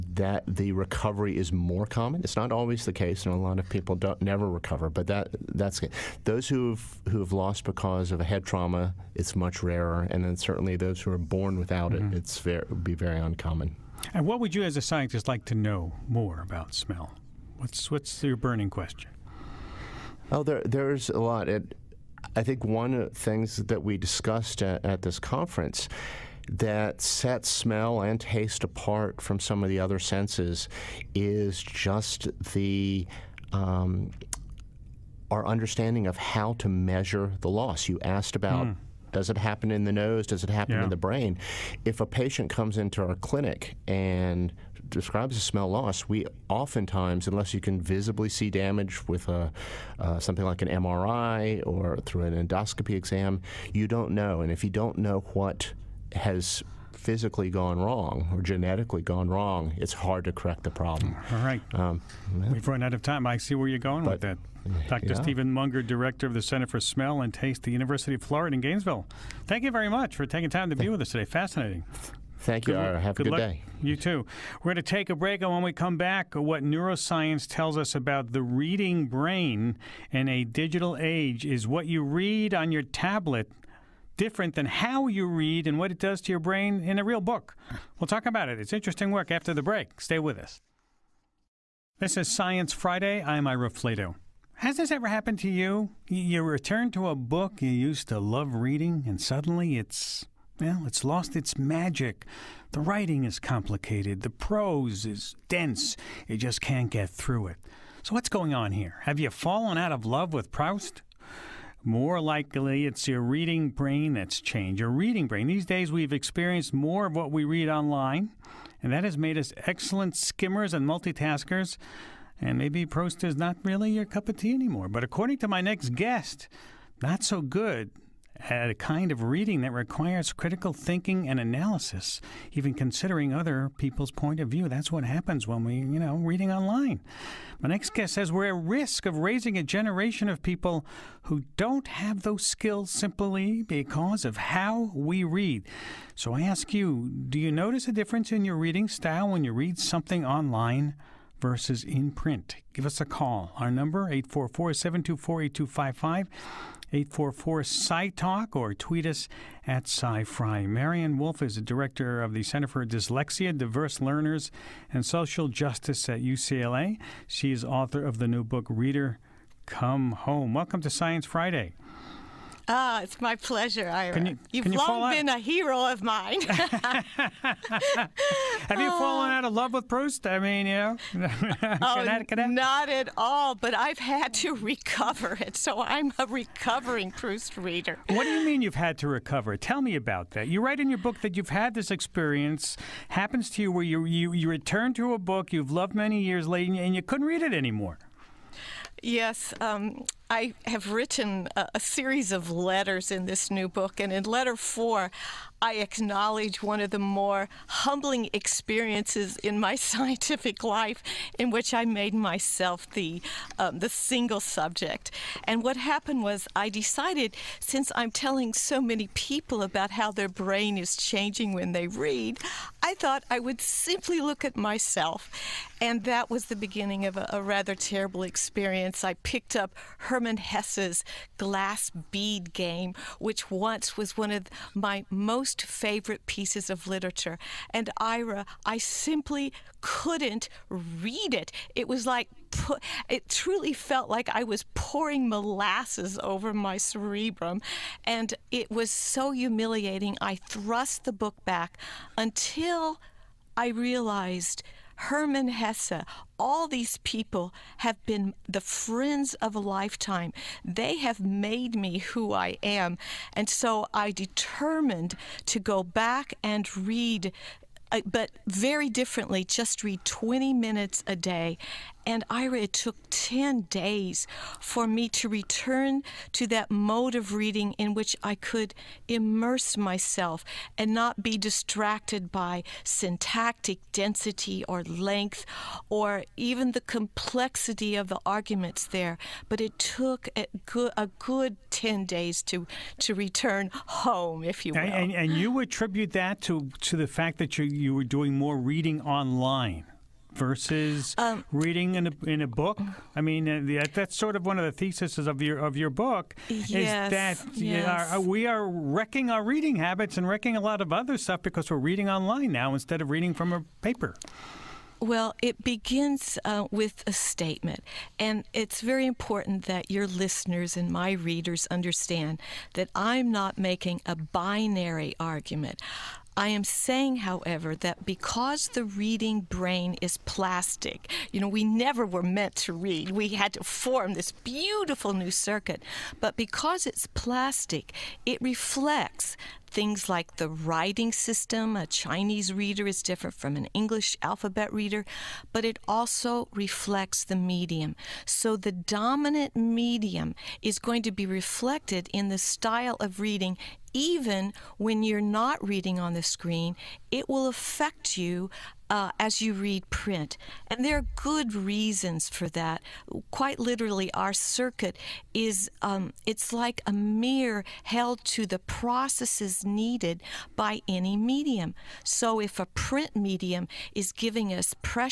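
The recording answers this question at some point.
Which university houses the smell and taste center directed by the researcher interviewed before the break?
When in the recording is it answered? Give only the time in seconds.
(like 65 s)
67 s.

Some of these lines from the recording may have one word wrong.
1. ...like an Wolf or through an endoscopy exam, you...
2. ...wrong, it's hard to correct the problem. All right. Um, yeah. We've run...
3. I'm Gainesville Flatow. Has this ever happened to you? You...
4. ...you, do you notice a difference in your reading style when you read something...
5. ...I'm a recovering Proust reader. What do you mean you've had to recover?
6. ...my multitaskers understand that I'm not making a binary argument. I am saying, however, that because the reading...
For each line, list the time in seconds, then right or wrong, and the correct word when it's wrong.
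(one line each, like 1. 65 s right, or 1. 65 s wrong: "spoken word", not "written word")
1. 50 s wrong: "MRI", not "Wolf"
2. 59 s right
3. 93 s wrong: "Ira", not "Gainesville"
4. 146 s right
5. 185 s right
6. 320 s wrong: "readers", not "multitaskers".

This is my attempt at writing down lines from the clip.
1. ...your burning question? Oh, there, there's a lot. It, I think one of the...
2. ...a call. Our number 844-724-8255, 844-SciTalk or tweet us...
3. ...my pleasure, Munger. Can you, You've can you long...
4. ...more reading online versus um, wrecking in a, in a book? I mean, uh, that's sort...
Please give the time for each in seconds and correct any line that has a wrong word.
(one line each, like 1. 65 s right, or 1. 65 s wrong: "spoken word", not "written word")
1. 18 s right
2. 153 s right
3. 173 s wrong: "Ira", not "Munger"
4. 298 s wrong: "reading", not "wrecking".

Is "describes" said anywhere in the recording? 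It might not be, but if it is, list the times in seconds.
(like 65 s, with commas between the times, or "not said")
44 s.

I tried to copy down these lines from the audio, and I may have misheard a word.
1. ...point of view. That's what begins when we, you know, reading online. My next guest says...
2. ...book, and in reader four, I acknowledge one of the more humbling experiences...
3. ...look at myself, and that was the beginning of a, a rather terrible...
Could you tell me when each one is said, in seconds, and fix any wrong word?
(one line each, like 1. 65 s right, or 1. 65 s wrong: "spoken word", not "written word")
1. 134 s wrong: "happens", not "begins"
2. 203 s wrong: "letter", not "reader"
3. 224 s right.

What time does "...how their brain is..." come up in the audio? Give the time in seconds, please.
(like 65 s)
219 s.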